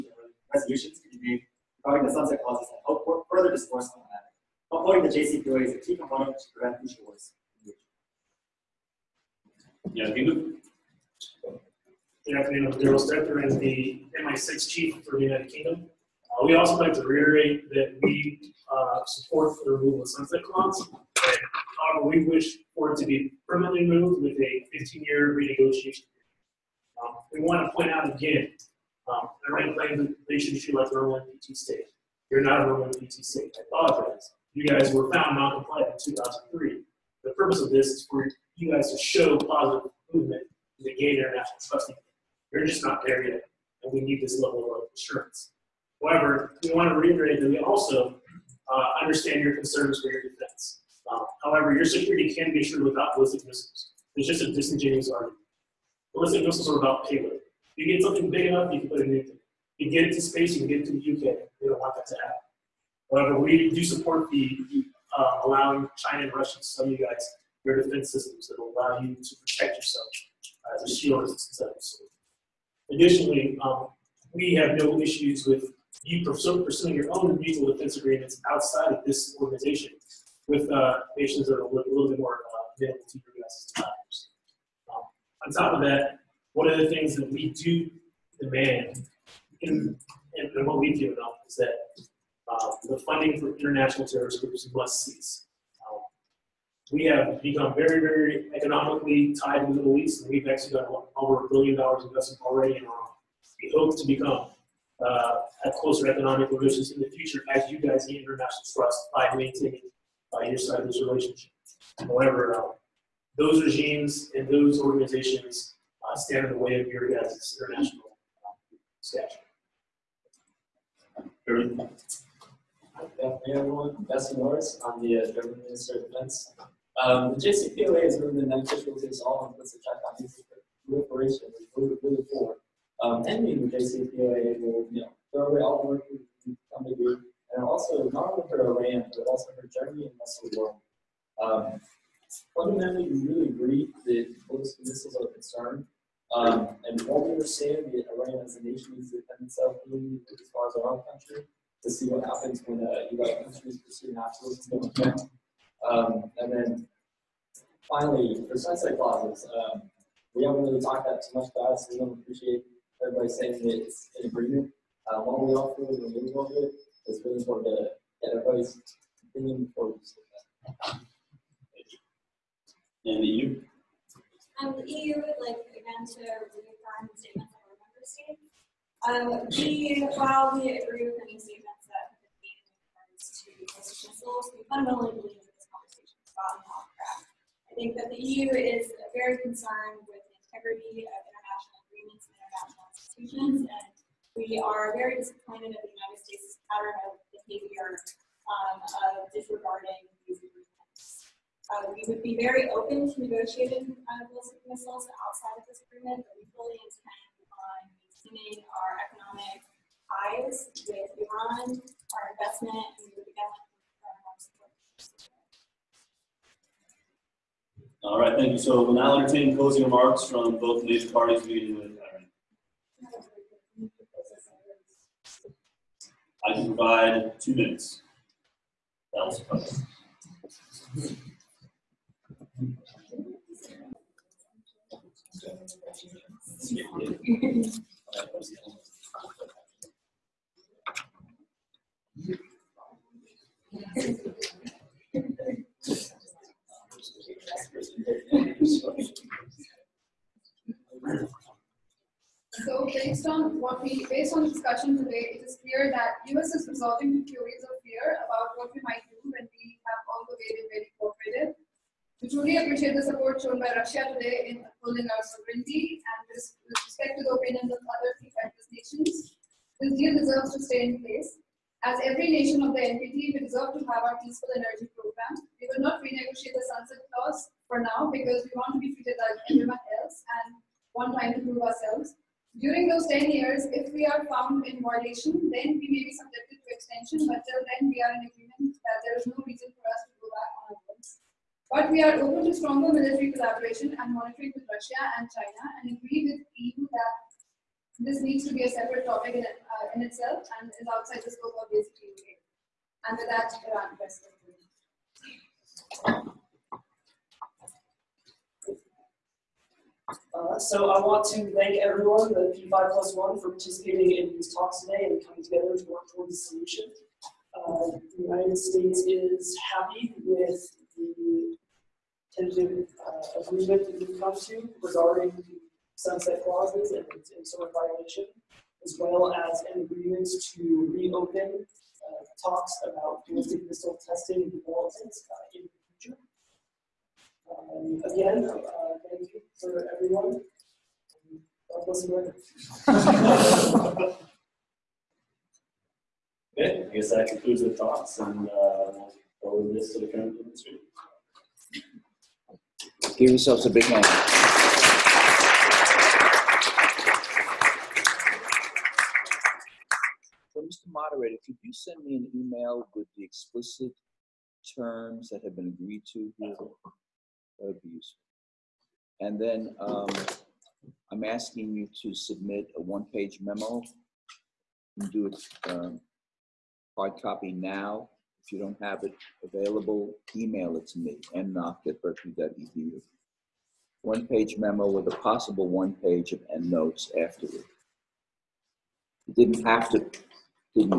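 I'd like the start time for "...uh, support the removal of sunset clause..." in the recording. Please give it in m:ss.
0:18.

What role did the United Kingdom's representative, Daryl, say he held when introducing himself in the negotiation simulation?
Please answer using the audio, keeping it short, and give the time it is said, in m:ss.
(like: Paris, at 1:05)
MI6 Chief, at 0:14.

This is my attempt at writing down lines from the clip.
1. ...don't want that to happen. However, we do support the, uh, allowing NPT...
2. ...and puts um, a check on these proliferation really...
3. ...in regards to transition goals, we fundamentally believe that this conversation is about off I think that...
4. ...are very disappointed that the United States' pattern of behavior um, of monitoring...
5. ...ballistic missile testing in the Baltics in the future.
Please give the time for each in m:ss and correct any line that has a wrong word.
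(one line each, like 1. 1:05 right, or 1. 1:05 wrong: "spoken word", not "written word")
1. 1:01 wrong: "China", not "NPT"
2. 2:09 right
3. 3:02 right
4. 3:14 wrong: "disregarding", not "monitoring"
5. 5:33 right.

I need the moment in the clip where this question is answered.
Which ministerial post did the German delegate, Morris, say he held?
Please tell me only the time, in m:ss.
2:05.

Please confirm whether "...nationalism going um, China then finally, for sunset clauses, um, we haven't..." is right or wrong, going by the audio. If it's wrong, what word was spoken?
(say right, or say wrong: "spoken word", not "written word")
wrong: "And", not "China".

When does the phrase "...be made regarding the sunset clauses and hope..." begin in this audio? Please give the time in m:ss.
0:01.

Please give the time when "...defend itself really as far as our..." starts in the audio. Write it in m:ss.
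2:29.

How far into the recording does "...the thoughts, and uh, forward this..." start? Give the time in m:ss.
5:47.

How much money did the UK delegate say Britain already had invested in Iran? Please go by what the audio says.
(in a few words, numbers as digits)
over a billion dollars.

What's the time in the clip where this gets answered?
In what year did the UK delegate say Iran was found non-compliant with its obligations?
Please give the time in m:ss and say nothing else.
0:36.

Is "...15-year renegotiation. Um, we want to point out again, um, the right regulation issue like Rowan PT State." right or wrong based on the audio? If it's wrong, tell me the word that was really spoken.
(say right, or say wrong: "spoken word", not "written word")
right.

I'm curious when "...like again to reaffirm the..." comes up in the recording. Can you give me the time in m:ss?
2:55.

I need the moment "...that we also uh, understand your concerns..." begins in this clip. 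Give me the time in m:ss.
0:47.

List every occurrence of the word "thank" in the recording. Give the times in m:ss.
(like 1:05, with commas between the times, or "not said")
3:38, 5:11.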